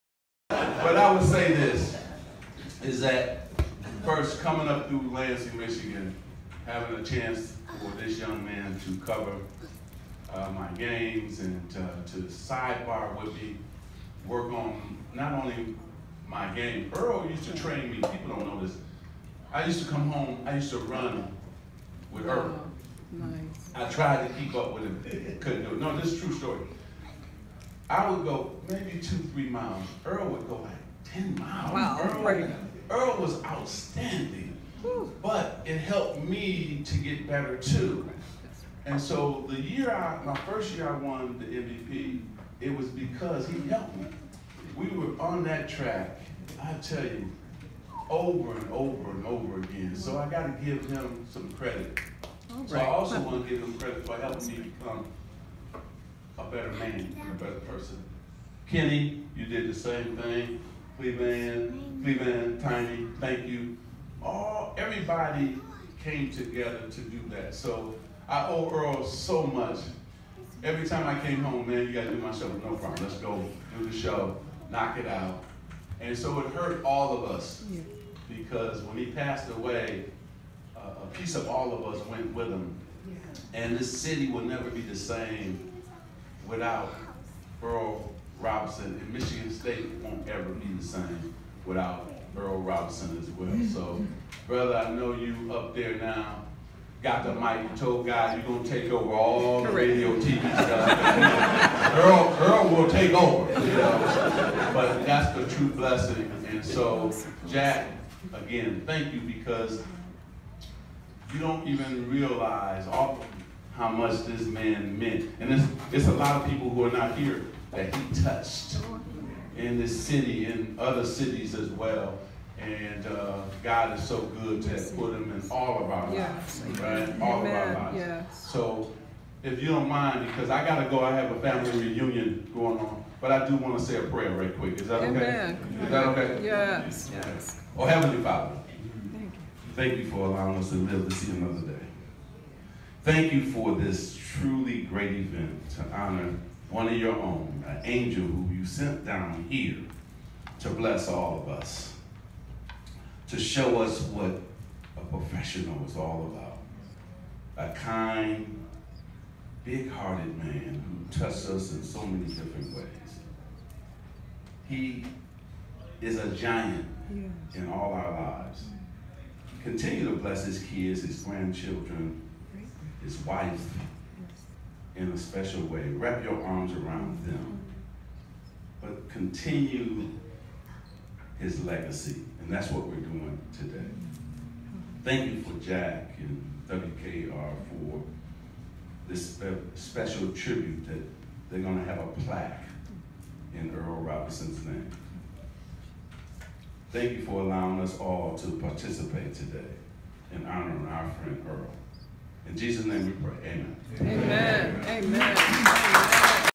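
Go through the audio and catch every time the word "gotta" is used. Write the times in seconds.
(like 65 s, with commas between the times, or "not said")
50 s, 71 s.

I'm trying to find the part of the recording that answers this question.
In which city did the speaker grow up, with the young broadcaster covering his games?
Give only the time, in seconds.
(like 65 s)
5 s.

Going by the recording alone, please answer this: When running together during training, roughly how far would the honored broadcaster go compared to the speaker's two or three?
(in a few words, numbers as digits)
10 miles.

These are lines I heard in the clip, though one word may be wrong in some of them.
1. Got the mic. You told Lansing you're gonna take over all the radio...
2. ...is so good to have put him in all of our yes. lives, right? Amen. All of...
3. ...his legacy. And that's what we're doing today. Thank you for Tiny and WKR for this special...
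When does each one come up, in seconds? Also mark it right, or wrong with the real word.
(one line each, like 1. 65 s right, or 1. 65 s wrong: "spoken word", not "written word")
1. 97 s wrong: "God", not "Lansing"
2. 123 s right
3. 181 s wrong: "Jack", not "Tiny".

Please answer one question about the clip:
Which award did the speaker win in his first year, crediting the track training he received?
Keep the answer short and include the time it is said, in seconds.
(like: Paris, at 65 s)
MVP, at 41 s.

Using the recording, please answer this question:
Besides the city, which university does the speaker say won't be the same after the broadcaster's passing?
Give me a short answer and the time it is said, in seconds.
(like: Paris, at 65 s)
Michigan State, at 89 s.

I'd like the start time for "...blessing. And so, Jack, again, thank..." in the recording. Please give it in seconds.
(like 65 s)
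105 s.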